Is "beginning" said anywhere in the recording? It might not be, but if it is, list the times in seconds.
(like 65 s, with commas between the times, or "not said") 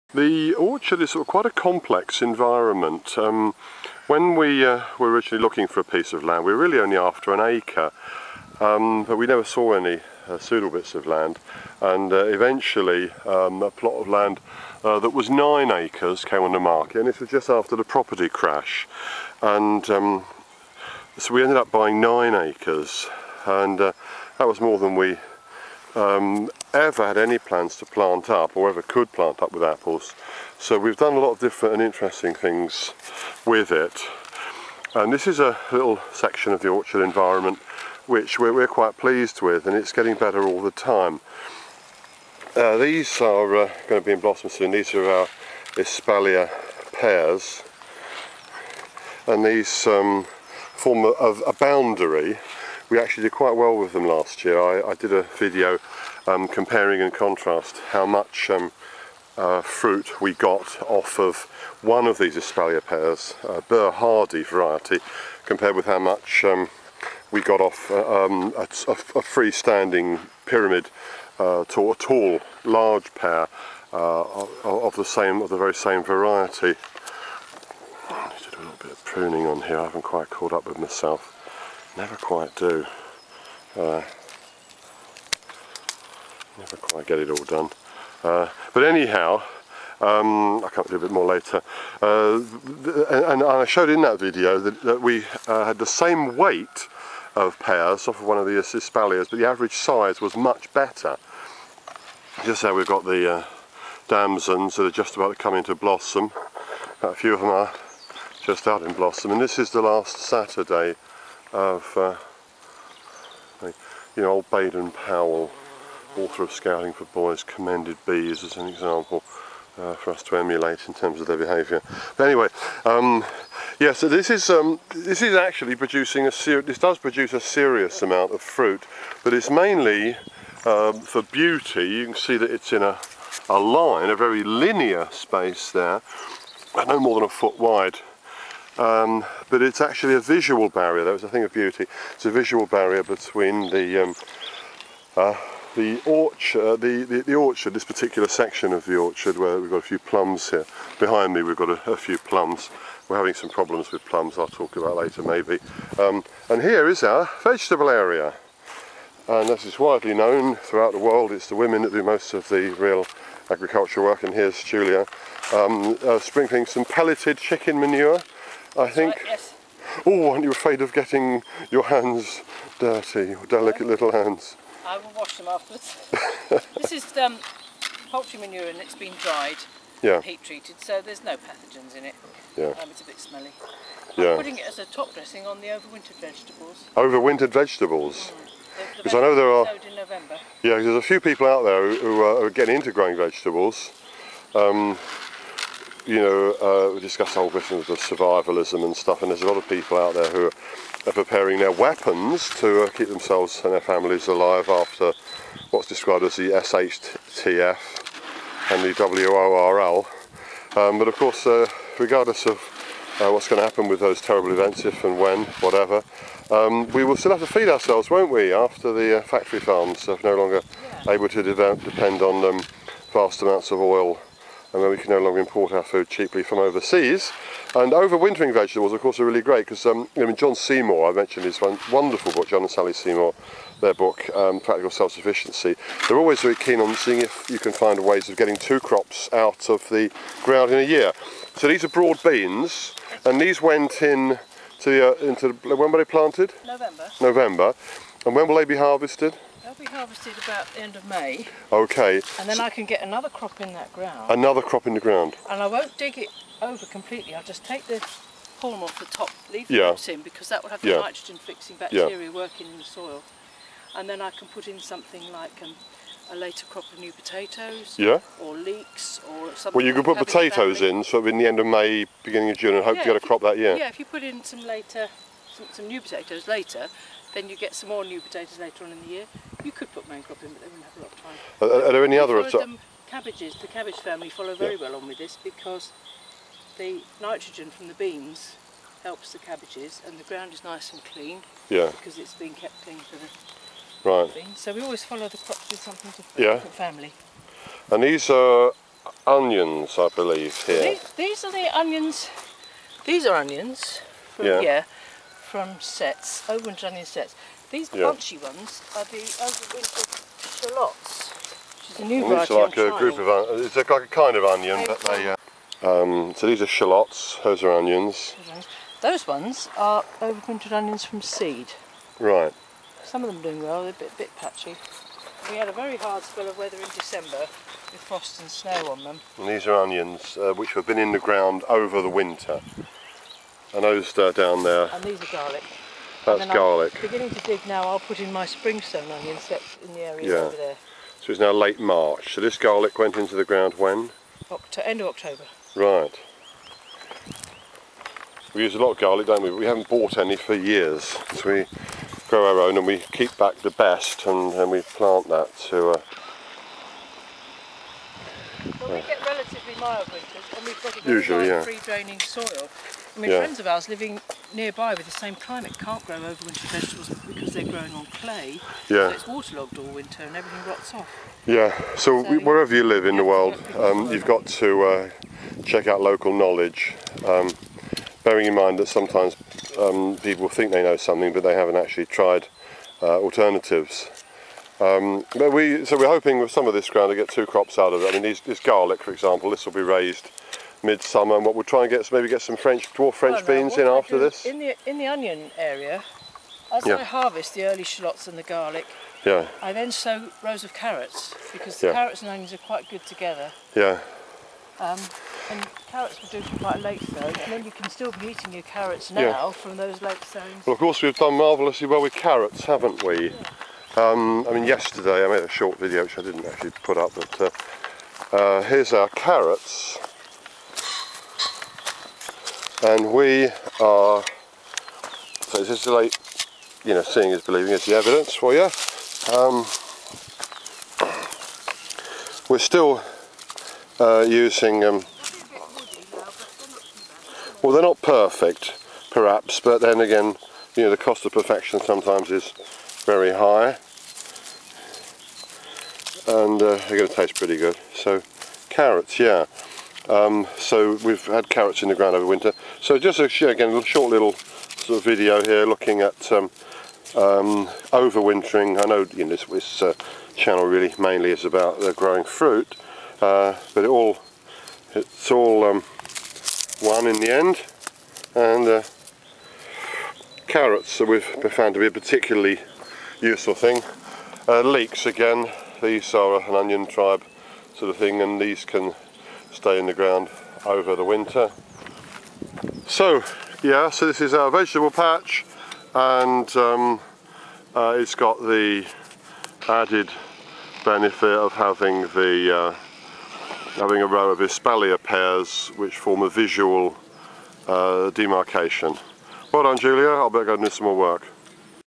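272 s, 337 s.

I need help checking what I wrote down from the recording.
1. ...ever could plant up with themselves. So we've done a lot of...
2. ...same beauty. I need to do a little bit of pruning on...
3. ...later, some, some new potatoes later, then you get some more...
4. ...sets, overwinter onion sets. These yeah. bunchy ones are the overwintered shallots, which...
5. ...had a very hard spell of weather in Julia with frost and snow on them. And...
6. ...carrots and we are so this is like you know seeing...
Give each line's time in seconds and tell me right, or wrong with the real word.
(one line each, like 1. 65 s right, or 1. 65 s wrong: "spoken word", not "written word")
1. 28 s wrong: "apples", not "themselves"
2. 75 s wrong: "variety", not "beauty"
3. 274 s right
4. 305 s right
5. 325 s wrong: "December", not "Julia"
6. 419 s right.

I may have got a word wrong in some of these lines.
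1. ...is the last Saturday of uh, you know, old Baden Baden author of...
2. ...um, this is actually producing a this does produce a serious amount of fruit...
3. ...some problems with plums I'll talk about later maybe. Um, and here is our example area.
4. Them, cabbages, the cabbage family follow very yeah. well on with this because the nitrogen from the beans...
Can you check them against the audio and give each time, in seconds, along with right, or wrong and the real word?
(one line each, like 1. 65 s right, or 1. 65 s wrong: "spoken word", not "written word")
1. 109 s wrong: "Powell", not "Baden"
2. 124 s right
3. 153 s wrong: "vegetable", not "example"
4. 282 s right.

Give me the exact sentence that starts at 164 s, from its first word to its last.
And here's Julia um, uh, sprinkling some pelleted chicken manure, I think.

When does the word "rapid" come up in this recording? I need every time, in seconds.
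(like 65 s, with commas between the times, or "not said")
not said.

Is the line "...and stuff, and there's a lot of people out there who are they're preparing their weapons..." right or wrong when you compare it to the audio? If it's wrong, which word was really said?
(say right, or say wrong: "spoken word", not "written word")
right.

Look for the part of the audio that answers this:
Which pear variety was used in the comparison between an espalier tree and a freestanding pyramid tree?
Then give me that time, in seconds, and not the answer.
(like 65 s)
63 s.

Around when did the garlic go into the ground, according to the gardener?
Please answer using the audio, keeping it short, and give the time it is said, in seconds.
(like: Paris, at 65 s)
End of October, at 344 s.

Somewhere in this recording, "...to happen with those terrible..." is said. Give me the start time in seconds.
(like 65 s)
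213 s.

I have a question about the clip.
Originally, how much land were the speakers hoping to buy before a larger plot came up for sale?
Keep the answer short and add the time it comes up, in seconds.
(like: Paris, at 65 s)
1 acre, at 7 s.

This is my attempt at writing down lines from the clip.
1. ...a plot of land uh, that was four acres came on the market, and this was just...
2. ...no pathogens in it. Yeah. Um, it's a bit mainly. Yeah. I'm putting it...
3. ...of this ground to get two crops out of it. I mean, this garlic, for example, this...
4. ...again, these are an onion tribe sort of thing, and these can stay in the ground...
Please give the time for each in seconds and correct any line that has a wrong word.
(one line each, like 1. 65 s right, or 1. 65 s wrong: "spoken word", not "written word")
1. 13 s wrong: "nine", not "four"
2. 181 s wrong: "smelly", not "mainly"
3. 386 s right
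4. 475 s right.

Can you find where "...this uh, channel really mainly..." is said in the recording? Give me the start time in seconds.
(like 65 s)
459 s.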